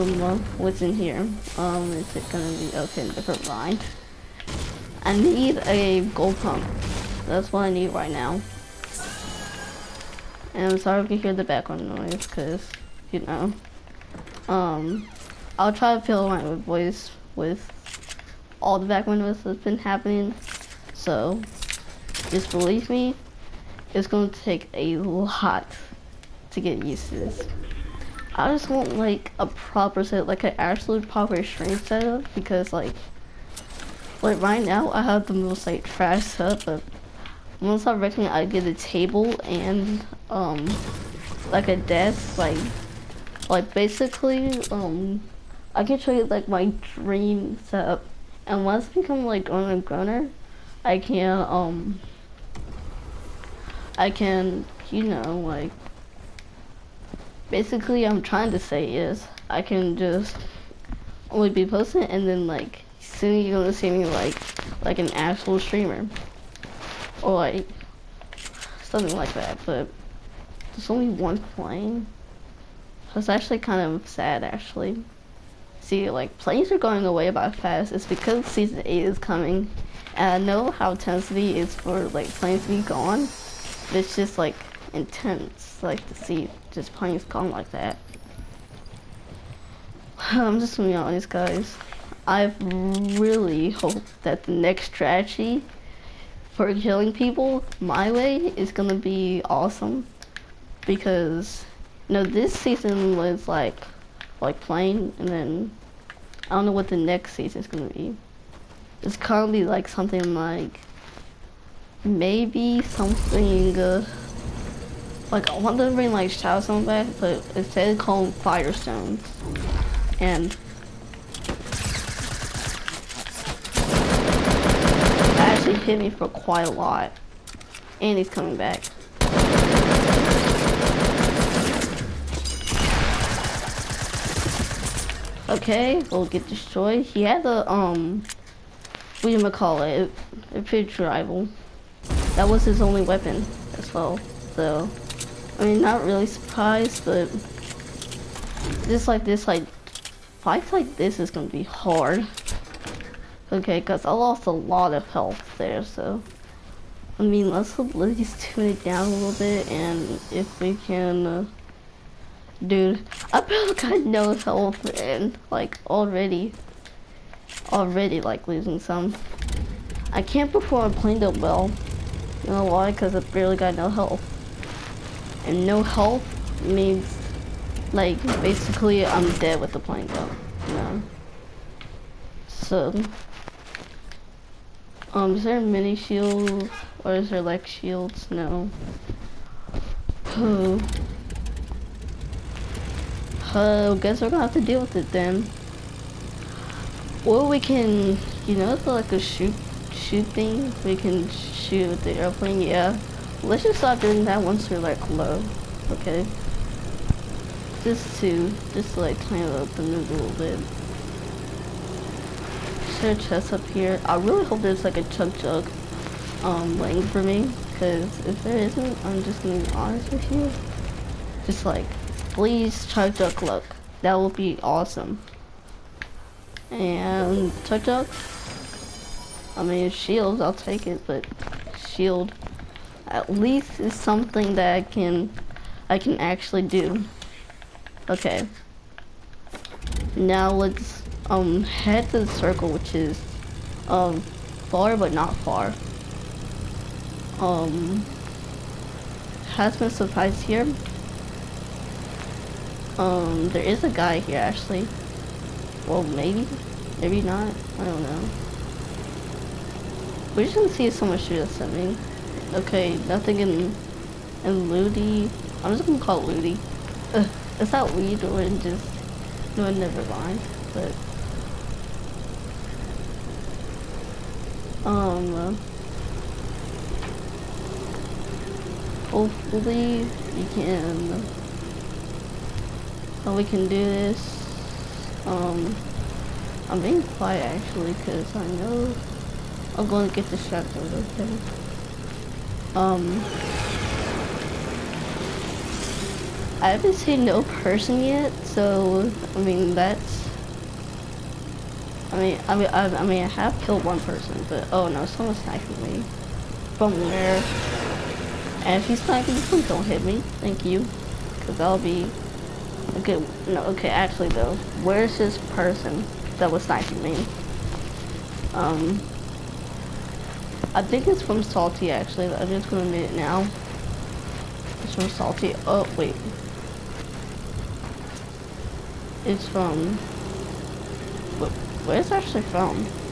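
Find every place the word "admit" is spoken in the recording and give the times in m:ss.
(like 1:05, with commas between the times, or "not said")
5:22.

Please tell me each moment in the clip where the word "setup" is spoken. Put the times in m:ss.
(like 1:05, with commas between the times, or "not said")
0:31, 0:36, 0:47.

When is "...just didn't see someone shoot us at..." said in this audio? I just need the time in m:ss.
4:20.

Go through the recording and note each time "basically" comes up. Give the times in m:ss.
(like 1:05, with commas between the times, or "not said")
0:43, 0:57, 2:58.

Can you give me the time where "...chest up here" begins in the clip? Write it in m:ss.
3:33.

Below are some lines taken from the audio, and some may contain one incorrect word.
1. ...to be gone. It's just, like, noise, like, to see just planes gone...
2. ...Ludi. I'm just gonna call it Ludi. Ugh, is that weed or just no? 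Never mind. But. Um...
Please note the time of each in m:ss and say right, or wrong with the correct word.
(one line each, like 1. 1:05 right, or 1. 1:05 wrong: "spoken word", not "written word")
1. 1:22 wrong: "intense", not "noise"
2. 4:24 right.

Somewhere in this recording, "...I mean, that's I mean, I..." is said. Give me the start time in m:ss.
4:59.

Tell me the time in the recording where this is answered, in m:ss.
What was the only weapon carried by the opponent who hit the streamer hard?
2:20.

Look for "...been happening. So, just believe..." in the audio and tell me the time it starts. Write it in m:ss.
0:19.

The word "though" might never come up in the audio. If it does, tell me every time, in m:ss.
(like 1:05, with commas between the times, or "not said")
3:00, 5:14.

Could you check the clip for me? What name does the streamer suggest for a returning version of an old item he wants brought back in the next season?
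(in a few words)
Firestone.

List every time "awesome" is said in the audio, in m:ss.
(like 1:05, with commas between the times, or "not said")
1:39, 3:44.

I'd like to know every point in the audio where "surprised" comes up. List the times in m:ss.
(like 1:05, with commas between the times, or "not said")
2:26, 4:09.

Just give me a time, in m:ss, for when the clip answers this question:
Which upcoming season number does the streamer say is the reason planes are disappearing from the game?
1:18.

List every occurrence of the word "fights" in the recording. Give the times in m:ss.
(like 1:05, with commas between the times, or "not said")
2:30.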